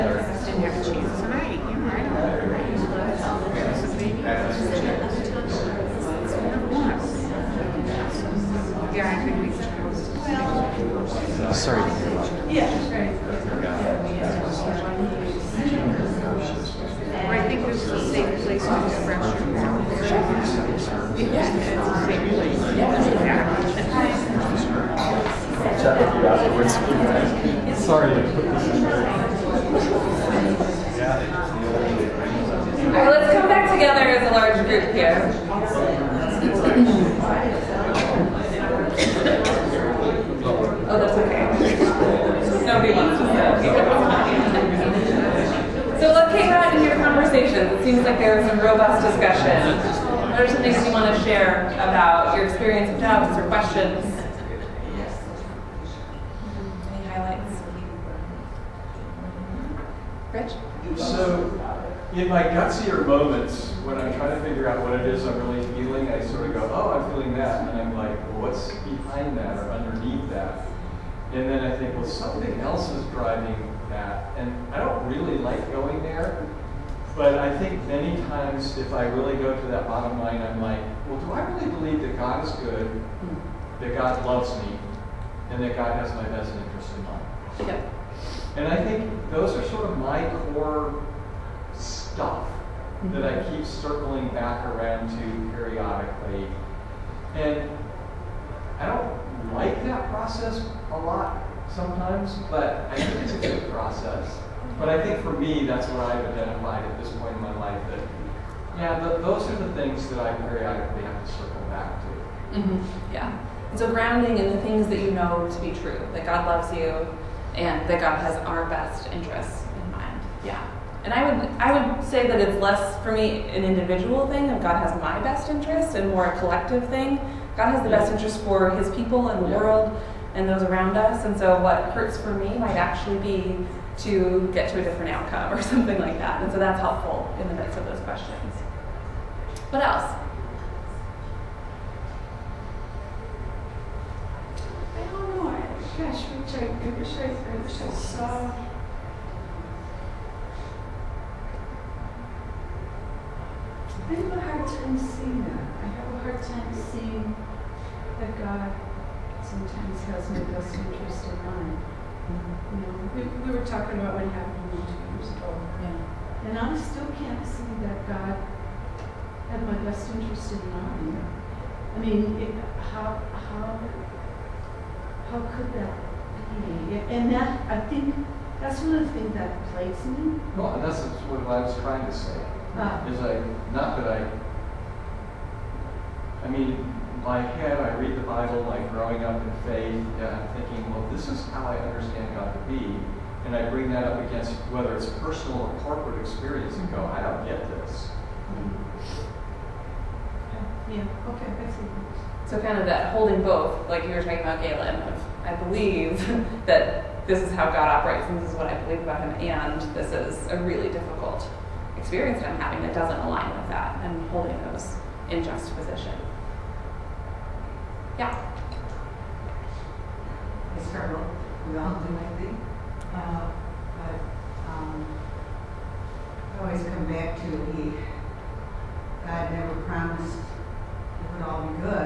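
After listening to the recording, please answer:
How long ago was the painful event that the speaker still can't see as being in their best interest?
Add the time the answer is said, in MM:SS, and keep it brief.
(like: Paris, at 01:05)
2 years ago, at 02:44.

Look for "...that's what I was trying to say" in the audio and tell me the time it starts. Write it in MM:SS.
03:00.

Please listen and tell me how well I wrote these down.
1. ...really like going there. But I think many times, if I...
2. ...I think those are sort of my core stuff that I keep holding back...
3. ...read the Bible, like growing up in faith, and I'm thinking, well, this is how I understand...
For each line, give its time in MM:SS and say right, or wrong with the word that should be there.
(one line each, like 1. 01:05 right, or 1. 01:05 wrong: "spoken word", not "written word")
1. 01:15 right
2. 01:28 wrong: "circling", not "holding"
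3. 03:07 right.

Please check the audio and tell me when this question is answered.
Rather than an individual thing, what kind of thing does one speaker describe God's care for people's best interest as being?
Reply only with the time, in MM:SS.
02:06.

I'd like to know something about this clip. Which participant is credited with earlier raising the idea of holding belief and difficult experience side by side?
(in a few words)
Galen.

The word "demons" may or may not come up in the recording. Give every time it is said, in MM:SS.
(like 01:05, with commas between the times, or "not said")
not said.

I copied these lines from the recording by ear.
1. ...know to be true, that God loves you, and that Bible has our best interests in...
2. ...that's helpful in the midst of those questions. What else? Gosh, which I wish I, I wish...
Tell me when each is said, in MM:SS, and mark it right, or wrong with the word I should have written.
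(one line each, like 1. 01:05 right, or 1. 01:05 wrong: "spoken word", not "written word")
1. 01:55 wrong: "God", not "Bible"
2. 02:16 right.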